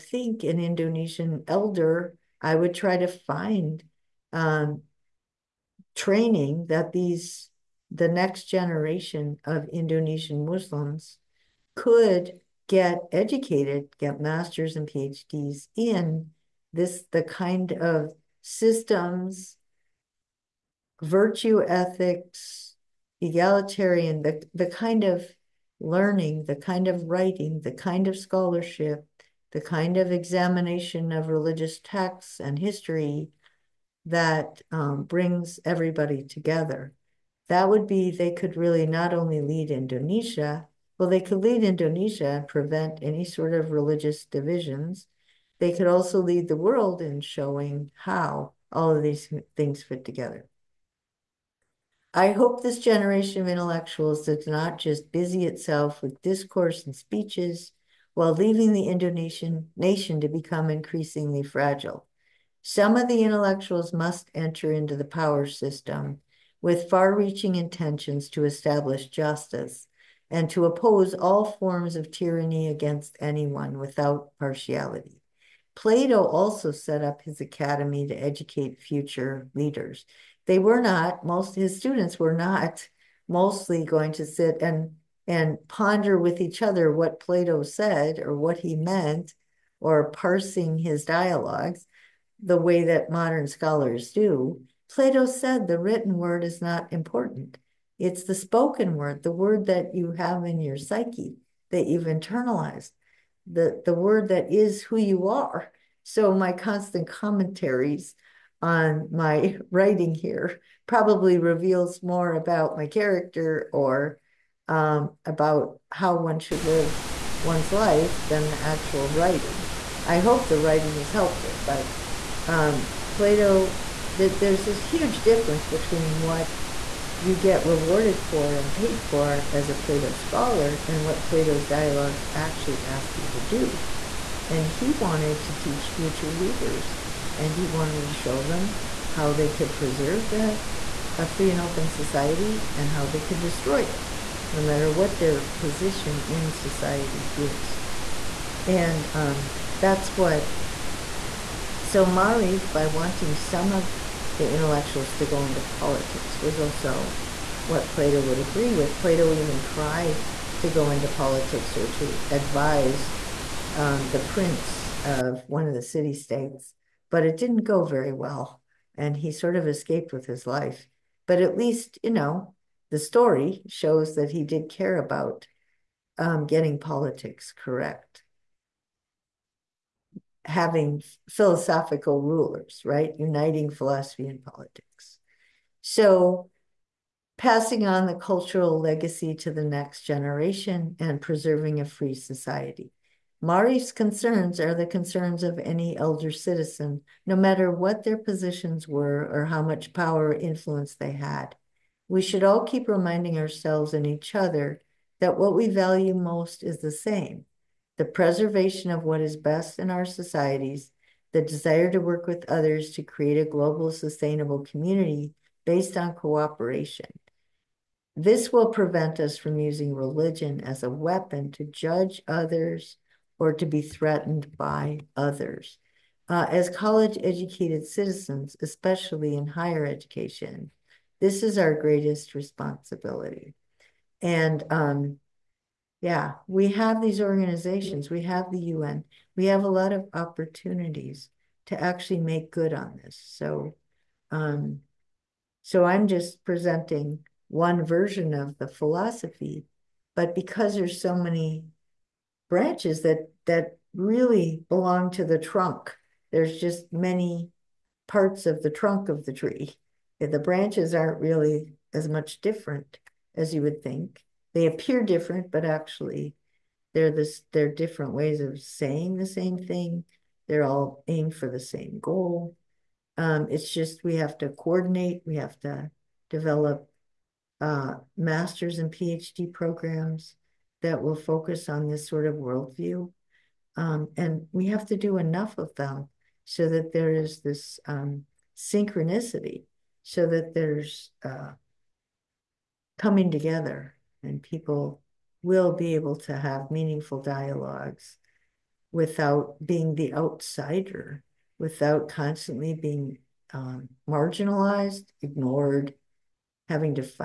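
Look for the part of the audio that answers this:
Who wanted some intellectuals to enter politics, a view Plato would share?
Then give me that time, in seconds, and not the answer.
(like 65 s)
152 s.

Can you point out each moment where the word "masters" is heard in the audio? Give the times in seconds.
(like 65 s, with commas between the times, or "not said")
14 s, 278 s.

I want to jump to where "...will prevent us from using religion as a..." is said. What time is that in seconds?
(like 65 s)
218 s.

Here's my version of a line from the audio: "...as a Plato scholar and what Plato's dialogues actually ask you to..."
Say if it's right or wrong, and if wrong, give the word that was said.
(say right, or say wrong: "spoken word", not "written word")
right.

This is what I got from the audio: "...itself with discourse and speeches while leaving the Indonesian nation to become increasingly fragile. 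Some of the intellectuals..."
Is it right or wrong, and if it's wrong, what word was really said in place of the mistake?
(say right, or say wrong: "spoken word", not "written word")
right.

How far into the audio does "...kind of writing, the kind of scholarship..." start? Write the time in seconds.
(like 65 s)
26 s.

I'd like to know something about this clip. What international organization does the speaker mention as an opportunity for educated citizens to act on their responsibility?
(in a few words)
The UN.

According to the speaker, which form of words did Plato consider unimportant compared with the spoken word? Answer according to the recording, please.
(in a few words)
The written word.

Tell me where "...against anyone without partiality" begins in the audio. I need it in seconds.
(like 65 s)
72 s.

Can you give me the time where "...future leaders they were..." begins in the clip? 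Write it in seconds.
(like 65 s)
78 s.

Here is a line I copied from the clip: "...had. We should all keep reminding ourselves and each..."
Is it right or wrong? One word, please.
right.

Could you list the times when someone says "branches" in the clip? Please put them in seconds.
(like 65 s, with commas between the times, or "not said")
252 s, 260 s.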